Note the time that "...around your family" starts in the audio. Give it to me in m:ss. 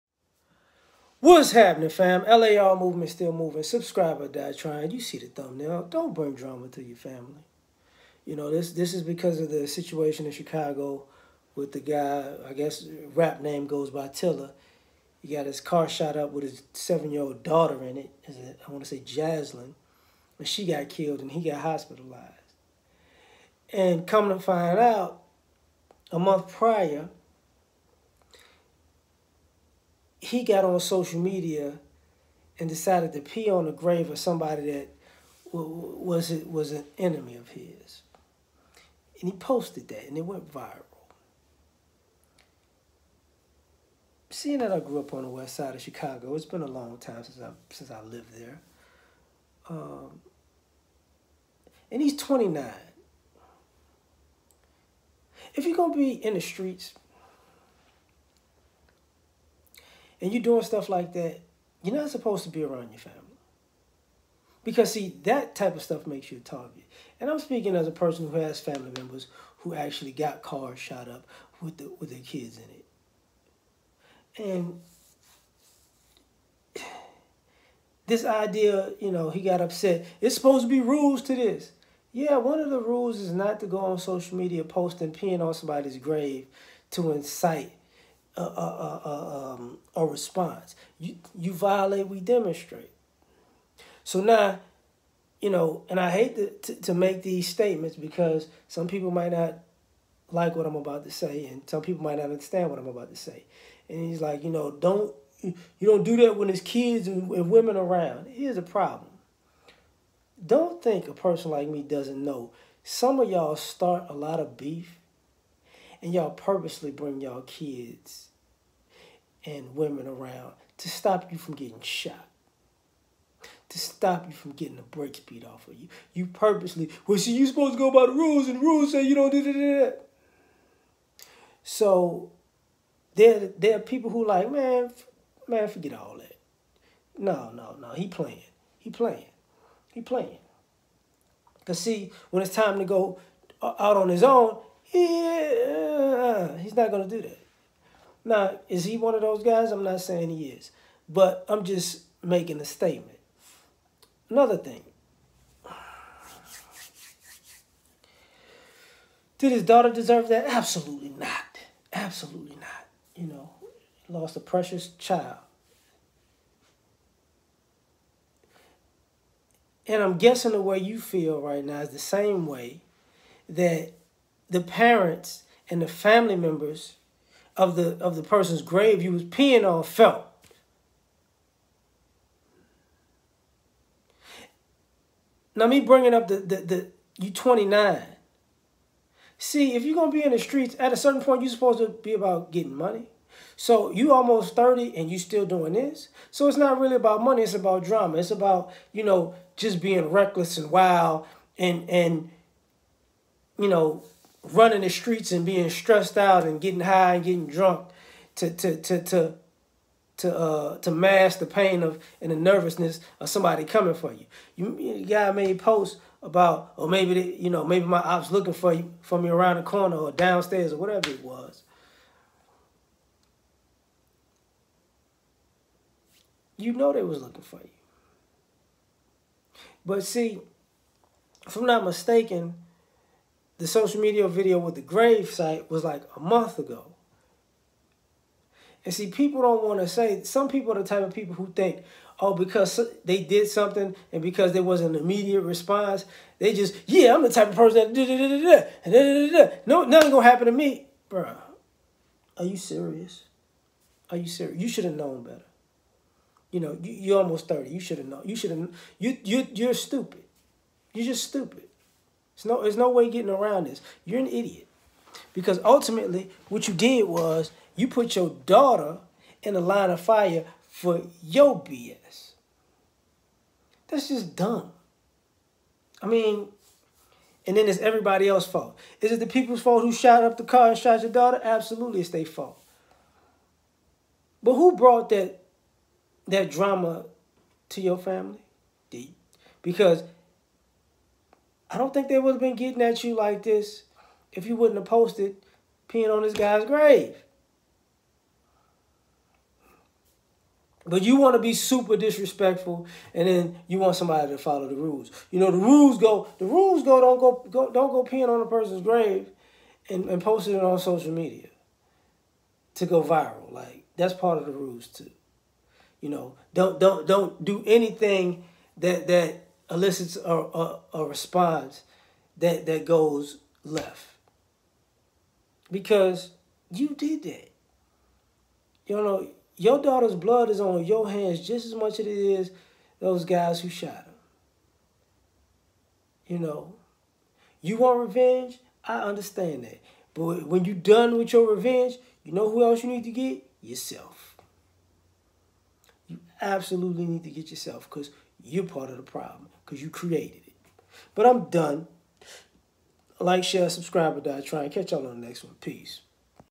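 1:02.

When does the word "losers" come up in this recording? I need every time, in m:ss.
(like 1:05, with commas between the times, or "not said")
not said.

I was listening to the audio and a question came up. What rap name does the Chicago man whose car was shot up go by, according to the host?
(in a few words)
Tiller.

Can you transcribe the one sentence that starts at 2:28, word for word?
Now, is he one of those guys?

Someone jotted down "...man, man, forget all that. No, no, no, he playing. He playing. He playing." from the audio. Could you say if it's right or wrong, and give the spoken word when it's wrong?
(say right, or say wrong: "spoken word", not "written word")
right.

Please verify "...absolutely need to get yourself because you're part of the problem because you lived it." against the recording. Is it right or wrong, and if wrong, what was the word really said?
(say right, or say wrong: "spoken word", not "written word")
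wrong: "created", not "lived".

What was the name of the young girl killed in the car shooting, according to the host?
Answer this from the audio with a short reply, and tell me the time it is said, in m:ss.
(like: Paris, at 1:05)
Jaslyn, at 0:19.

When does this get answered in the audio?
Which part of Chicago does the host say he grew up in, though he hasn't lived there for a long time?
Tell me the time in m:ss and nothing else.
0:45.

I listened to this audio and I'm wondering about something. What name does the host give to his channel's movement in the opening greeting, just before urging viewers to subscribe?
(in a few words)
LAR movement.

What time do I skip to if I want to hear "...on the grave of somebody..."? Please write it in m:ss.
0:33.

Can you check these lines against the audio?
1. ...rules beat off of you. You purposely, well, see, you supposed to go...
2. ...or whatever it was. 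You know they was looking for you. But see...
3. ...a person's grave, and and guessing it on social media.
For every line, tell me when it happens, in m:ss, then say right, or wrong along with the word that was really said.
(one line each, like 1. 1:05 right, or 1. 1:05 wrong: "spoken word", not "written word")
1. 2:04 wrong: "brakes", not "rules"
2. 3:40 right
3. 5:08 wrong: "posting", not "guessing".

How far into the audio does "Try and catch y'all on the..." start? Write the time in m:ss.
5:54.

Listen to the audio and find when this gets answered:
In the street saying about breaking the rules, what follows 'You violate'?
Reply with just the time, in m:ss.
1:32.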